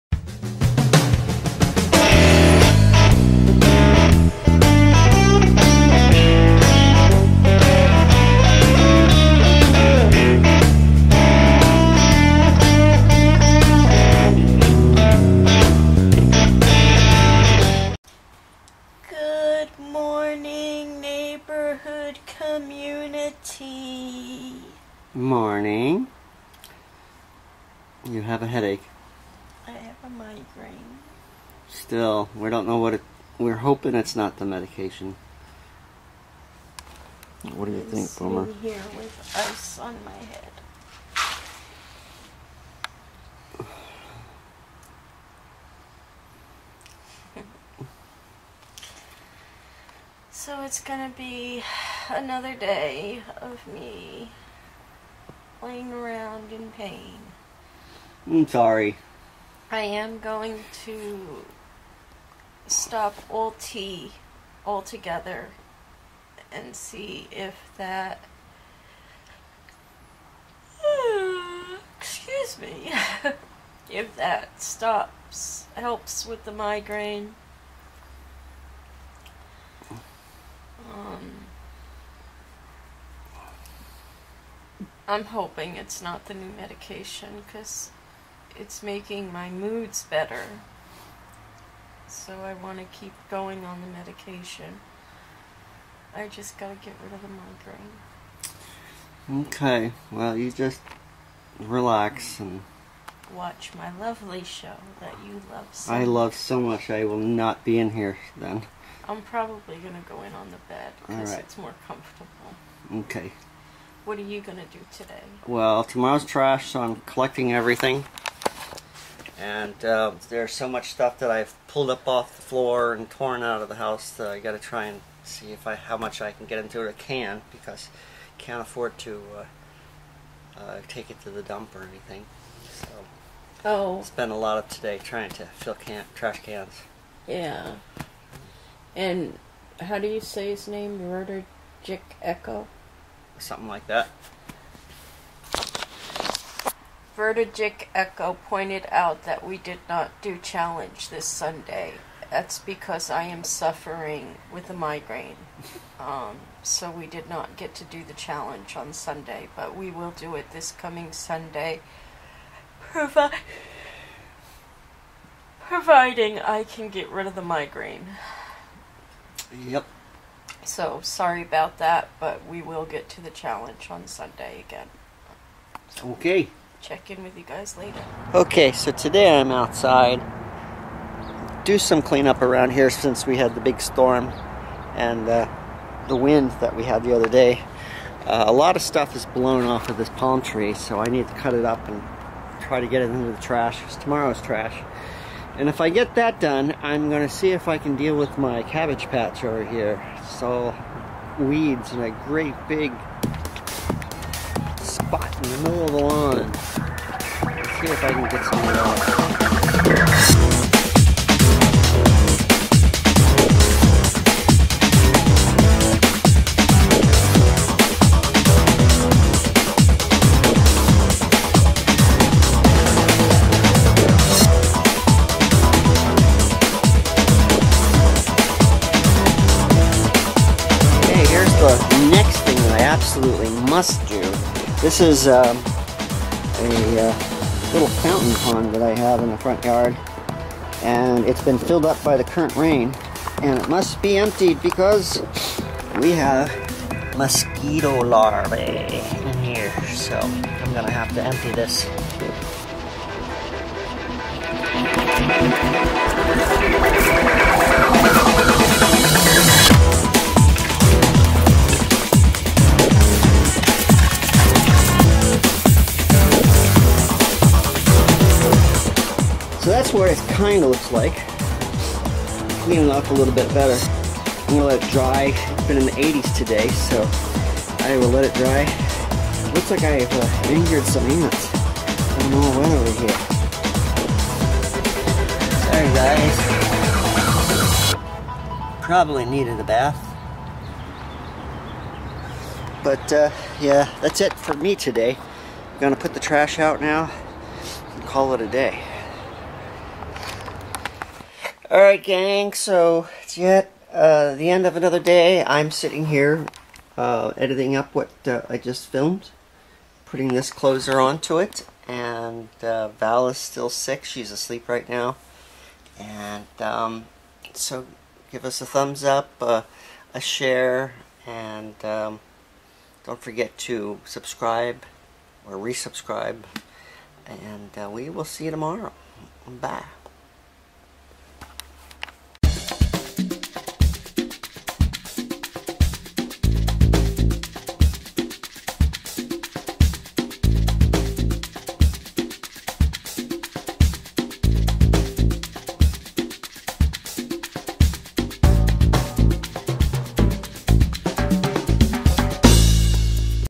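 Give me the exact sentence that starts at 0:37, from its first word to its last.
What do you I'm think, Boomer?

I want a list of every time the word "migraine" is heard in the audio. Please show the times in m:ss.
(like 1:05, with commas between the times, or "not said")
0:30, 1:16, 1:39, 2:34, 2:47.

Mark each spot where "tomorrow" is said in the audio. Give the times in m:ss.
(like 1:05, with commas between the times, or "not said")
1:55, 3:13, 5:28.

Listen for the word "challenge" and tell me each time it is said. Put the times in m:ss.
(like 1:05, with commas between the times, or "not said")
2:30, 2:38, 2:53.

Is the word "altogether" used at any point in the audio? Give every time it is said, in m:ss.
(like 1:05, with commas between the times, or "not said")
1:04.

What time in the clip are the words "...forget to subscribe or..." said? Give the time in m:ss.
5:23.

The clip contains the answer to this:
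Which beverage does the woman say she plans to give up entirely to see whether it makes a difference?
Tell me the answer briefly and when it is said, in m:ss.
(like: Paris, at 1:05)
tea, at 1:03.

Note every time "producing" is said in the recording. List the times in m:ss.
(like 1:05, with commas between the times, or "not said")
not said.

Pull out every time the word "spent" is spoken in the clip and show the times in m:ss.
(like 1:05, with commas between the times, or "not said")
2:14.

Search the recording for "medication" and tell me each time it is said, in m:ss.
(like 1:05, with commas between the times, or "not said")
0:34, 1:26, 1:33.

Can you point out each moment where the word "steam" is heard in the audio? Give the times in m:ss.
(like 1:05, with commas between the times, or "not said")
not said.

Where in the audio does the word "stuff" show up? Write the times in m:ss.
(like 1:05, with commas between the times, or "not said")
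2:00, 3:08.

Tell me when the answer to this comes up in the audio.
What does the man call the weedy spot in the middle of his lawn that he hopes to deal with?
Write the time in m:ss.
3:18.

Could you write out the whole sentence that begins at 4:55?
I'm gonna put the trash out now and call it a day.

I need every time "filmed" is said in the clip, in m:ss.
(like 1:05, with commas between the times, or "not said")
5:08.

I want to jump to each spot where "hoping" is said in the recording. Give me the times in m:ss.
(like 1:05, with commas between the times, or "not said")
0:33, 1:25.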